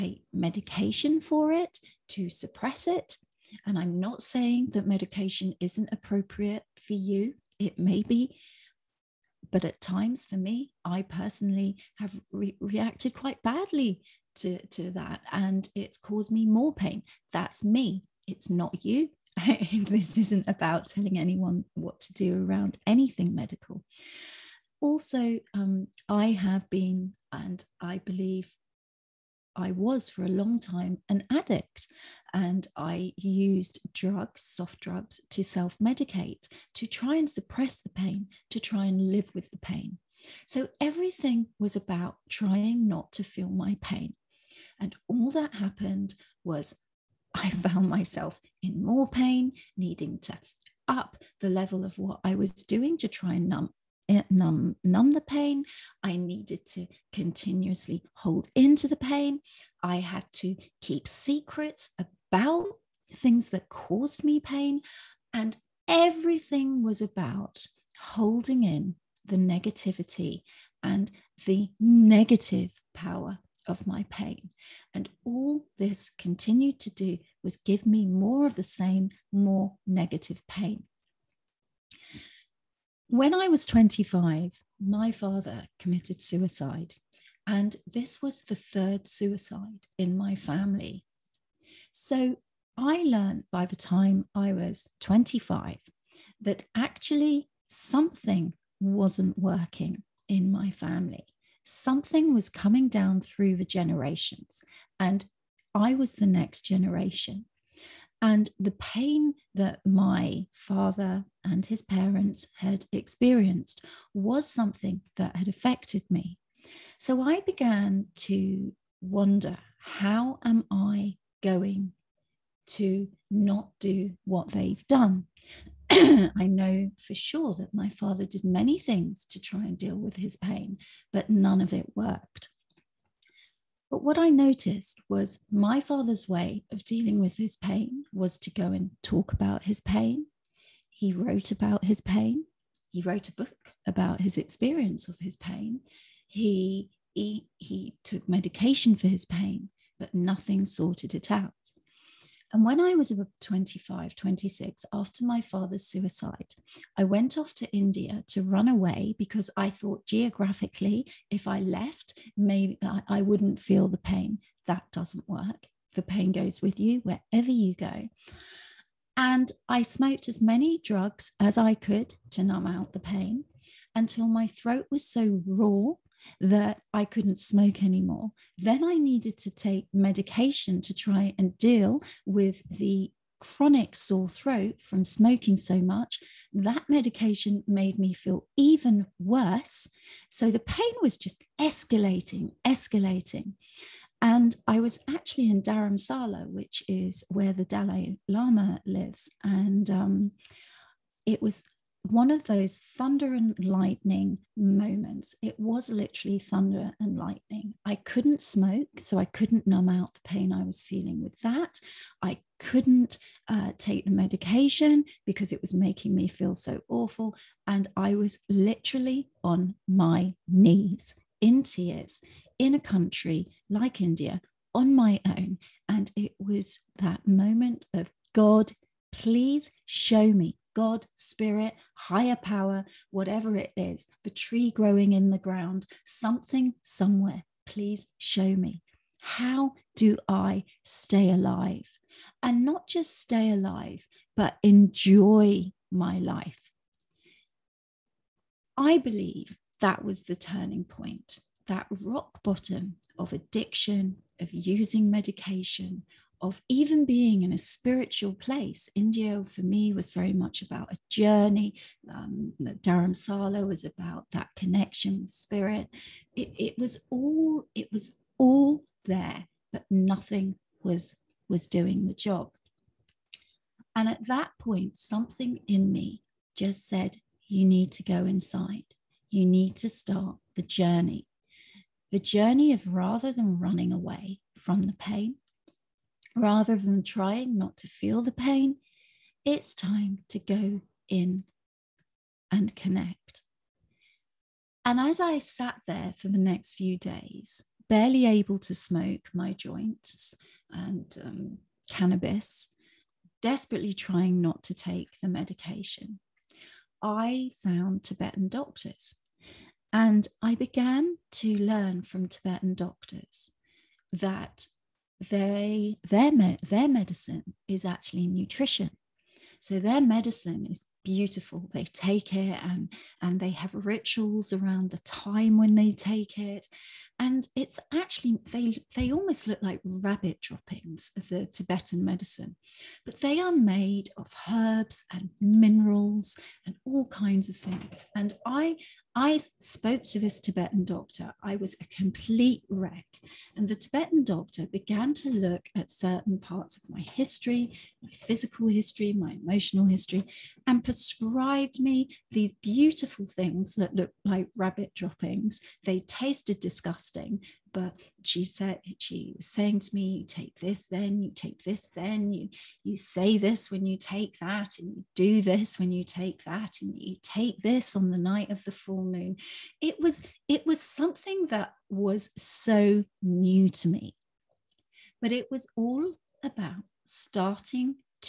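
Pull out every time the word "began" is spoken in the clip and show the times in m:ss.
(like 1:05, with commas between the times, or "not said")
1:57, 5:10, 5:44.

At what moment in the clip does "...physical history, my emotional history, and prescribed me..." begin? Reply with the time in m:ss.
5:48.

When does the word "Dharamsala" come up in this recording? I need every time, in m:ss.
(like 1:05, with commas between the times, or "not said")
3:15, 4:22.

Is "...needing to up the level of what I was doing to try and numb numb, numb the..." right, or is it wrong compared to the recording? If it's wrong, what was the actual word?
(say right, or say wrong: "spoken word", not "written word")
right.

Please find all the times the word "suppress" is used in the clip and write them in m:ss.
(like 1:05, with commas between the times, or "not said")
0:02, 0:37.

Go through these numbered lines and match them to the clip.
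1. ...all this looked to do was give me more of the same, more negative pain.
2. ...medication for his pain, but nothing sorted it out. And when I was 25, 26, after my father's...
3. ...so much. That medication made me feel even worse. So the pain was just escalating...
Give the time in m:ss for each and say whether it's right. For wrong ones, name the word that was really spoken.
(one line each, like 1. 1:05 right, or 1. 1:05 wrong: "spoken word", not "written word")
1. 1:15 wrong: "continued", not "looked"
2. 2:28 right
3. 3:05 right.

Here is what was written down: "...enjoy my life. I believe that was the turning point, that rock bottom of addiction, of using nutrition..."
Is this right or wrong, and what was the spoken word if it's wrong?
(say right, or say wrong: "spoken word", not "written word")
wrong: "medication", not "nutrition".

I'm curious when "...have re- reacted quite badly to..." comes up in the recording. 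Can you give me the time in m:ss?
0:11.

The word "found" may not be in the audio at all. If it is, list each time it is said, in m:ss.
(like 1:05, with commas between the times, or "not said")
0:47, 5:07.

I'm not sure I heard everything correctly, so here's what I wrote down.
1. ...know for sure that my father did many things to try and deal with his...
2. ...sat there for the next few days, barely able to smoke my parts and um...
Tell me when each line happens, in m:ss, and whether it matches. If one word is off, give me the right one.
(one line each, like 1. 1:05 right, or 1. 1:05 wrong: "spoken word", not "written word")
1. 2:06 right
2. 4:55 wrong: "joints", not "parts".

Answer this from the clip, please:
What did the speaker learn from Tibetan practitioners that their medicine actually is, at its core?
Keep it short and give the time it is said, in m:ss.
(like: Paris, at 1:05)
Nutrition, at 5:18.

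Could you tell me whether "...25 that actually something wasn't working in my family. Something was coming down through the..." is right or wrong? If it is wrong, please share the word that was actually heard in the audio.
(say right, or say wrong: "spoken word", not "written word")
right.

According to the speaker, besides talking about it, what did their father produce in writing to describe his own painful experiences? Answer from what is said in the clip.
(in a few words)
A book.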